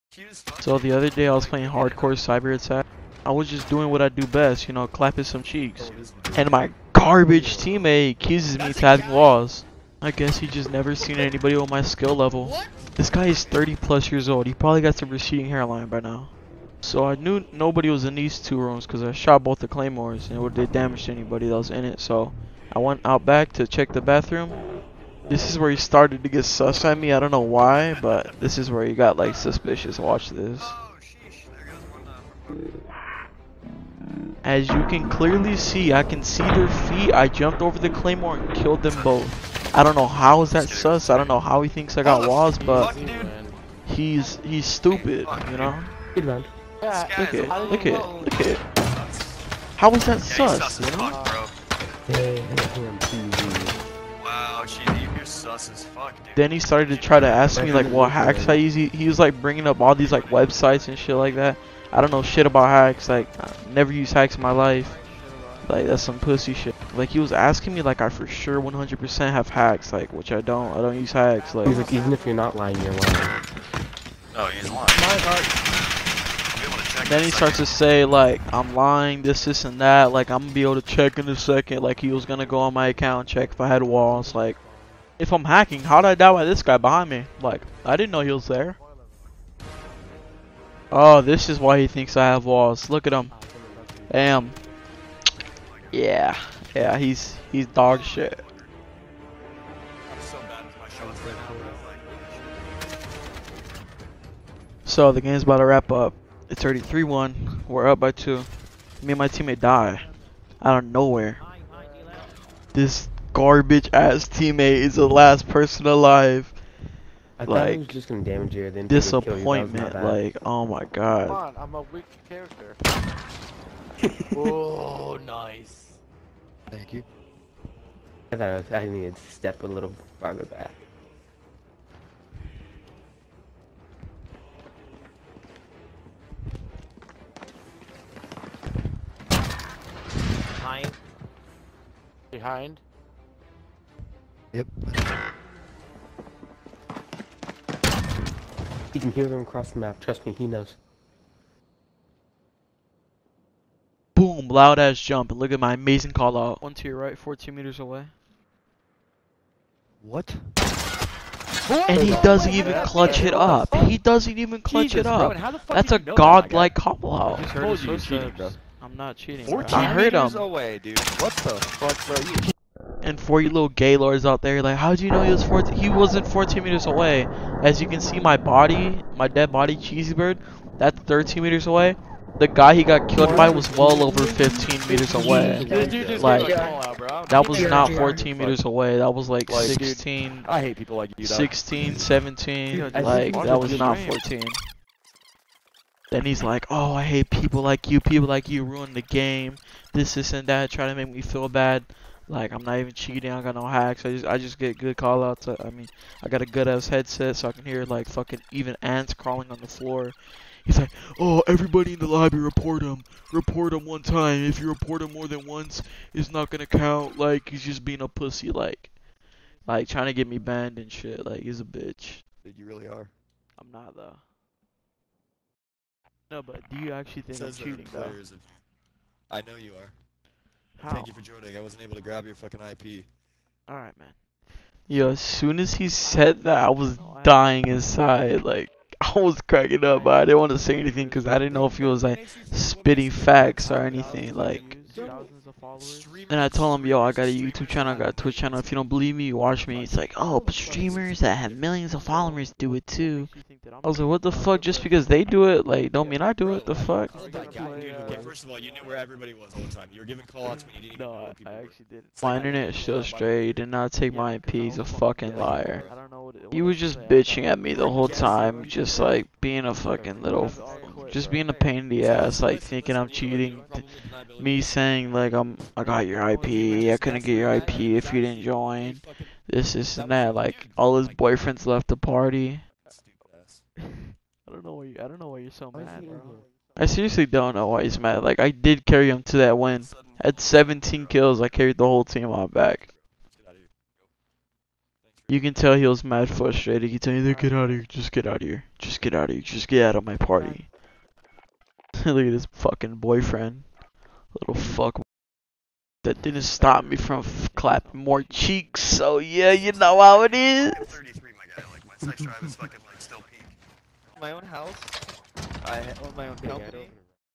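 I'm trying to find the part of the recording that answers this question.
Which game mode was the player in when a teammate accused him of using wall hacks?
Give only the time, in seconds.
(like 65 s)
1 s.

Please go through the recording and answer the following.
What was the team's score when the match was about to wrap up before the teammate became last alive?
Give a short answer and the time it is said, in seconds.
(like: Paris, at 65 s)
3-1, at 106 s.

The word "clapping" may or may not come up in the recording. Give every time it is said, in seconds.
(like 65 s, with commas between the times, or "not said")
4 s, 307 s.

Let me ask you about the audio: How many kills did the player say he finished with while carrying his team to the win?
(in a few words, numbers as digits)
17.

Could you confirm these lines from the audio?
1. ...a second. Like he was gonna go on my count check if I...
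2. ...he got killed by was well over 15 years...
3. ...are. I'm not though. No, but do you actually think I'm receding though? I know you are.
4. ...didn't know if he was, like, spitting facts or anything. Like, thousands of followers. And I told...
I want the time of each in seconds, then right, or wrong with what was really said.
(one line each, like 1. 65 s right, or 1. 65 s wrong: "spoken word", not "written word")
1. 81 s wrong: "account", not "count"
2. 182 s wrong: "meters", not "years"
3. 222 s wrong: "cheating", not "receding"
4. 241 s right.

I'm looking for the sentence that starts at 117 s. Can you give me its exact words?
I like, thought he was just gonna damage you, then disappointment.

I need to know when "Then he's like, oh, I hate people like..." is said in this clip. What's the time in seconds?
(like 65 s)
196 s.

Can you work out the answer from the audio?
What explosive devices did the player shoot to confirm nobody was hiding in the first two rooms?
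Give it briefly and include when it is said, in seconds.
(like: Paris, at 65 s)
Claymores, at 19 s.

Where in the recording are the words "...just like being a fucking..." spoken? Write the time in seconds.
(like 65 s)
268 s.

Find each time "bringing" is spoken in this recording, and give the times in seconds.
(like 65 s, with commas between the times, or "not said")
59 s.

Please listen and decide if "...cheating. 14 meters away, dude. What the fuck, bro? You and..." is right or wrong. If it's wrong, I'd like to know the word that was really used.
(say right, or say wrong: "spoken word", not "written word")
right.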